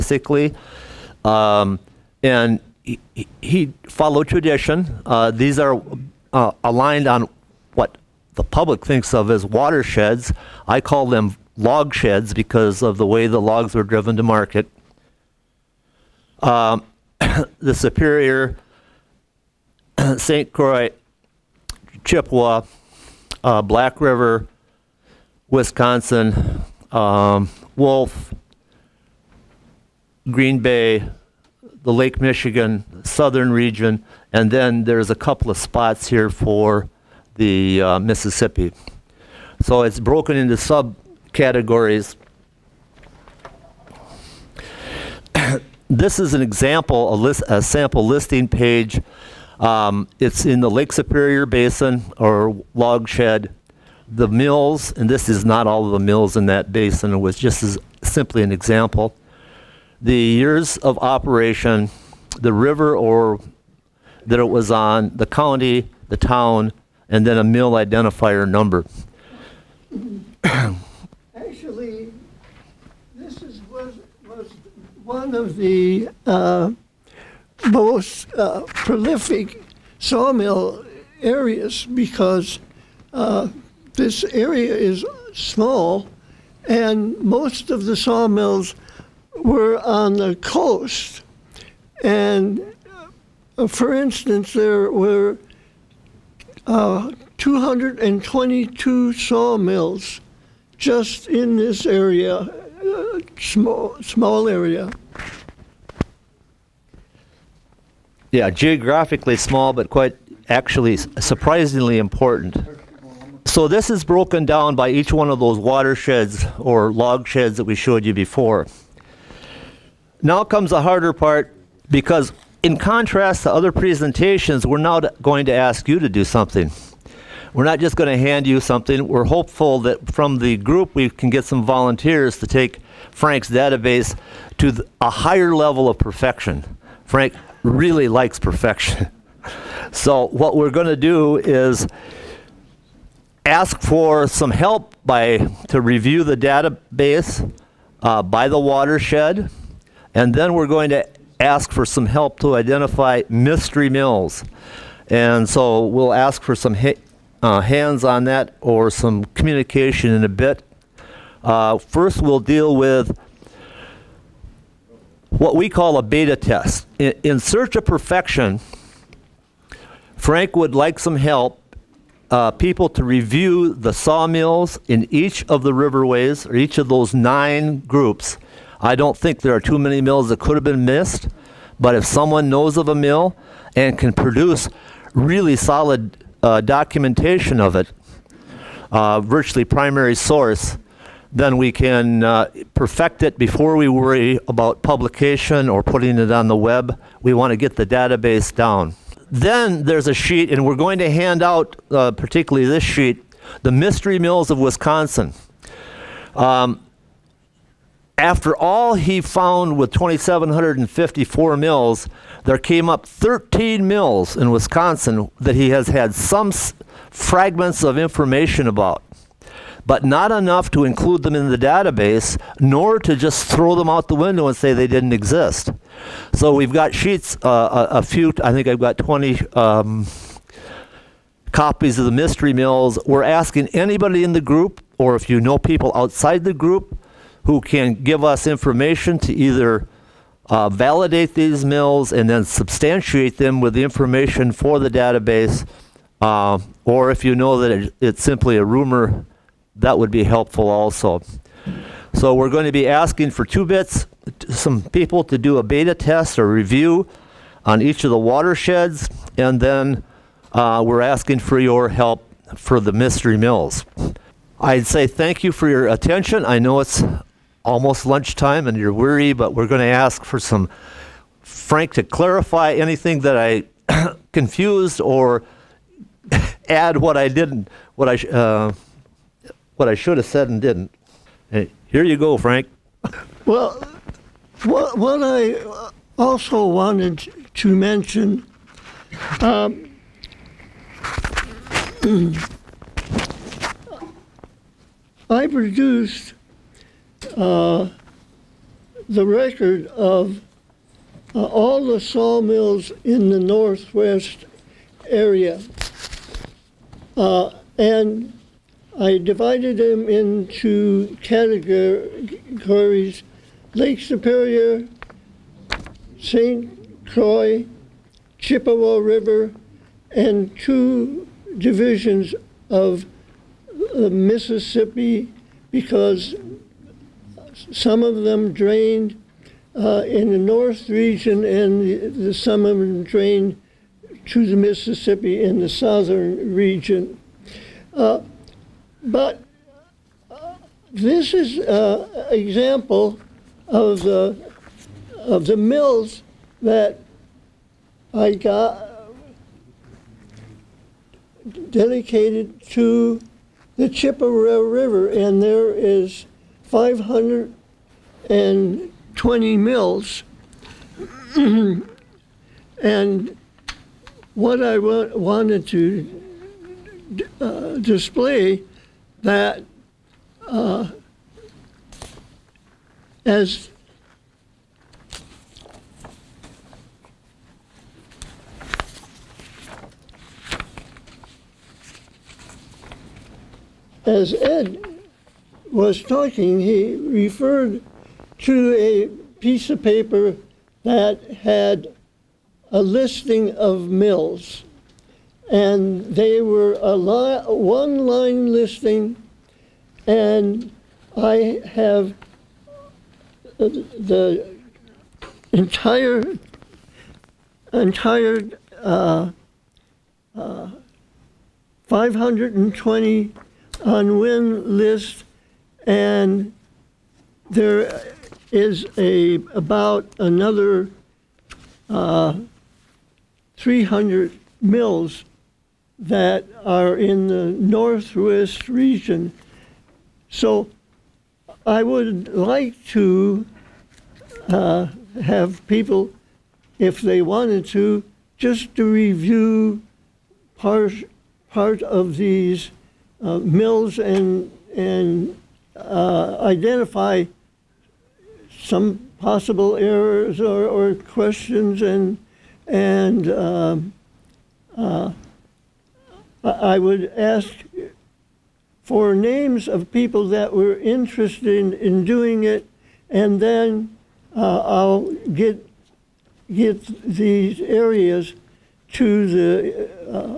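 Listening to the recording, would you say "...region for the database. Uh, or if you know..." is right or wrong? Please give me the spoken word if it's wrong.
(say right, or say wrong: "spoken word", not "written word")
wrong: "information", not "region".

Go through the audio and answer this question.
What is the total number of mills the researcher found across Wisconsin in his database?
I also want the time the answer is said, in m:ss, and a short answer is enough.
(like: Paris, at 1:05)
2,754, at 3:29.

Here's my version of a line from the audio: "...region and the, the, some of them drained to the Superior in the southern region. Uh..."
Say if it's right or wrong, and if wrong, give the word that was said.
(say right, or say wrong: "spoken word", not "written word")
wrong: "Mississippi", not "Superior".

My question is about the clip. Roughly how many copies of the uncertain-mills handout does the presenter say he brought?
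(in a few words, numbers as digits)
20.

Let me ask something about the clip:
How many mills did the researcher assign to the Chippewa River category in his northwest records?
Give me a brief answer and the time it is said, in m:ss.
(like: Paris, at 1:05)
520, at 5:56.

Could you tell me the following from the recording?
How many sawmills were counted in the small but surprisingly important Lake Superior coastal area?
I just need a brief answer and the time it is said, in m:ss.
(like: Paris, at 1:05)
222, at 1:37.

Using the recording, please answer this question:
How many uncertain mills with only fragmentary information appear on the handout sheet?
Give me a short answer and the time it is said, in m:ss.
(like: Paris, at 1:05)
13, at 3:33.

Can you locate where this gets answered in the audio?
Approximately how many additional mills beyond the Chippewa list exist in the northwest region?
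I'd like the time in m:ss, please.
7:03.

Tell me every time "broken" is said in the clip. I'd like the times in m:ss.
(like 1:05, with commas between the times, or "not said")
0:39, 1:54.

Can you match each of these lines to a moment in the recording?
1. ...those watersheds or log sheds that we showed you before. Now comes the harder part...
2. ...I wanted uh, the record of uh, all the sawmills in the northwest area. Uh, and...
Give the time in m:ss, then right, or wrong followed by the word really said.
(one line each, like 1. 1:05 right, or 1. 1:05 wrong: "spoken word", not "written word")
1. 1:55 right
2. 4:55 wrong: "produced", not "wanted".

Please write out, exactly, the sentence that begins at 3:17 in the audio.
We want to get the database down.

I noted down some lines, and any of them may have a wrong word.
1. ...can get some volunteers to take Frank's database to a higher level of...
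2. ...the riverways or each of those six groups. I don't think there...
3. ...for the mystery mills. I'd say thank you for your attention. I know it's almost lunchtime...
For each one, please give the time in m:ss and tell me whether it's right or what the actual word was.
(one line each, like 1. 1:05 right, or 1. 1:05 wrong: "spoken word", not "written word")
1. 2:11 right
2. 2:55 wrong: "nine", not "six"
3. 4:22 right.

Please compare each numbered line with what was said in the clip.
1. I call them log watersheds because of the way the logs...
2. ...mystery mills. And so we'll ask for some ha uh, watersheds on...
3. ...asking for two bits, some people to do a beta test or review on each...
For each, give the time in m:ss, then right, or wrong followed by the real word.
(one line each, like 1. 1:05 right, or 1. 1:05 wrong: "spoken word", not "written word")
1. 0:10 wrong: "sheds", not "watersheds"
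2. 2:33 wrong: "hands", not "watersheds"
3. 4:12 right.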